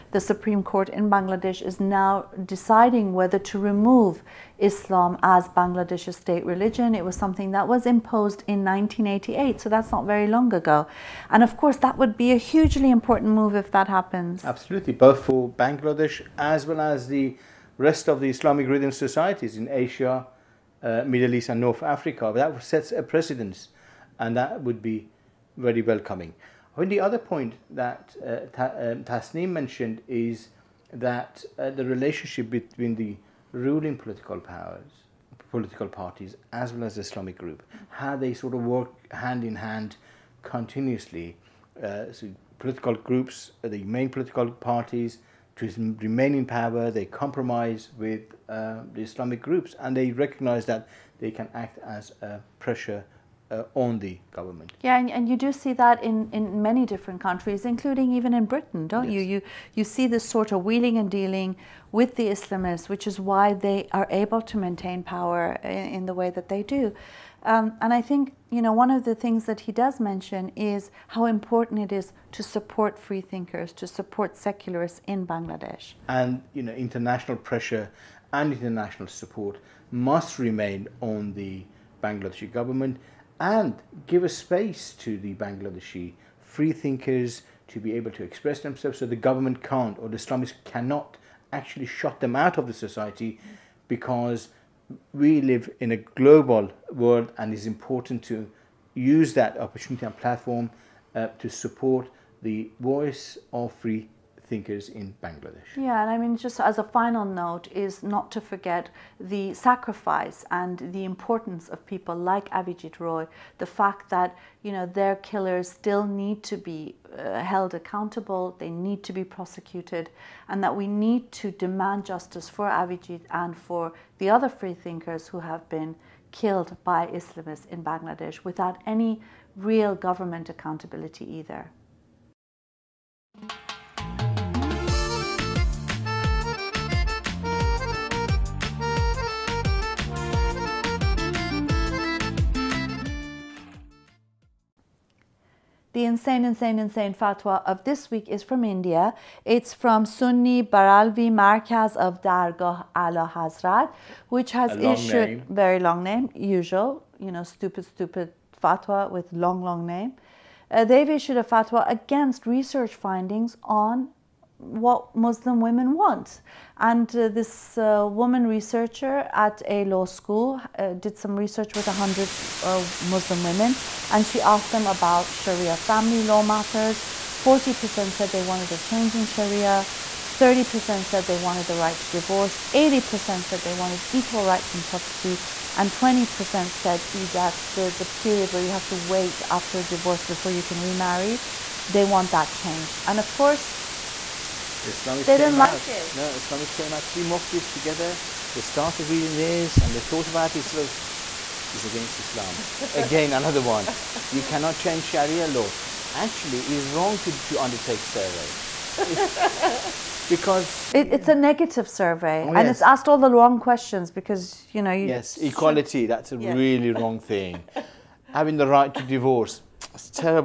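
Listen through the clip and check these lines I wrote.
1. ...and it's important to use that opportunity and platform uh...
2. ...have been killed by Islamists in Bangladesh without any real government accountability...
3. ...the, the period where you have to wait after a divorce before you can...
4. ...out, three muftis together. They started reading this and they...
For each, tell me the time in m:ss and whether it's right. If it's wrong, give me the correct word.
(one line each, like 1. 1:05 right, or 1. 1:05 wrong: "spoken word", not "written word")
1. 1:37 right
2. 2:05 right
3. 3:07 right
4. 3:16 right.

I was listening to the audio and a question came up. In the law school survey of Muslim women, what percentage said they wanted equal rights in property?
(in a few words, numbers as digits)
80%.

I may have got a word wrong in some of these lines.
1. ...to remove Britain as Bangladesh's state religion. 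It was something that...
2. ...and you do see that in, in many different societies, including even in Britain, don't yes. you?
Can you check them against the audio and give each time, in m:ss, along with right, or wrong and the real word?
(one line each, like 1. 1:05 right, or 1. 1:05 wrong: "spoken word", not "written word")
1. 0:03 wrong: "Islam", not "Britain"
2. 0:55 wrong: "countries", not "societies".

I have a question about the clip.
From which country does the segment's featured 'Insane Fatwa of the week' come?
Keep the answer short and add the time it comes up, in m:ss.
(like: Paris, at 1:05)
India, at 2:28.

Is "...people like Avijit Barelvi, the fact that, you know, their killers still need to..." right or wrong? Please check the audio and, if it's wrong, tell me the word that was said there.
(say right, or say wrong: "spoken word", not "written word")
wrong: "Roy", not "Barelvi".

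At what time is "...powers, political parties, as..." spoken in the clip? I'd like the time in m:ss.
0:34.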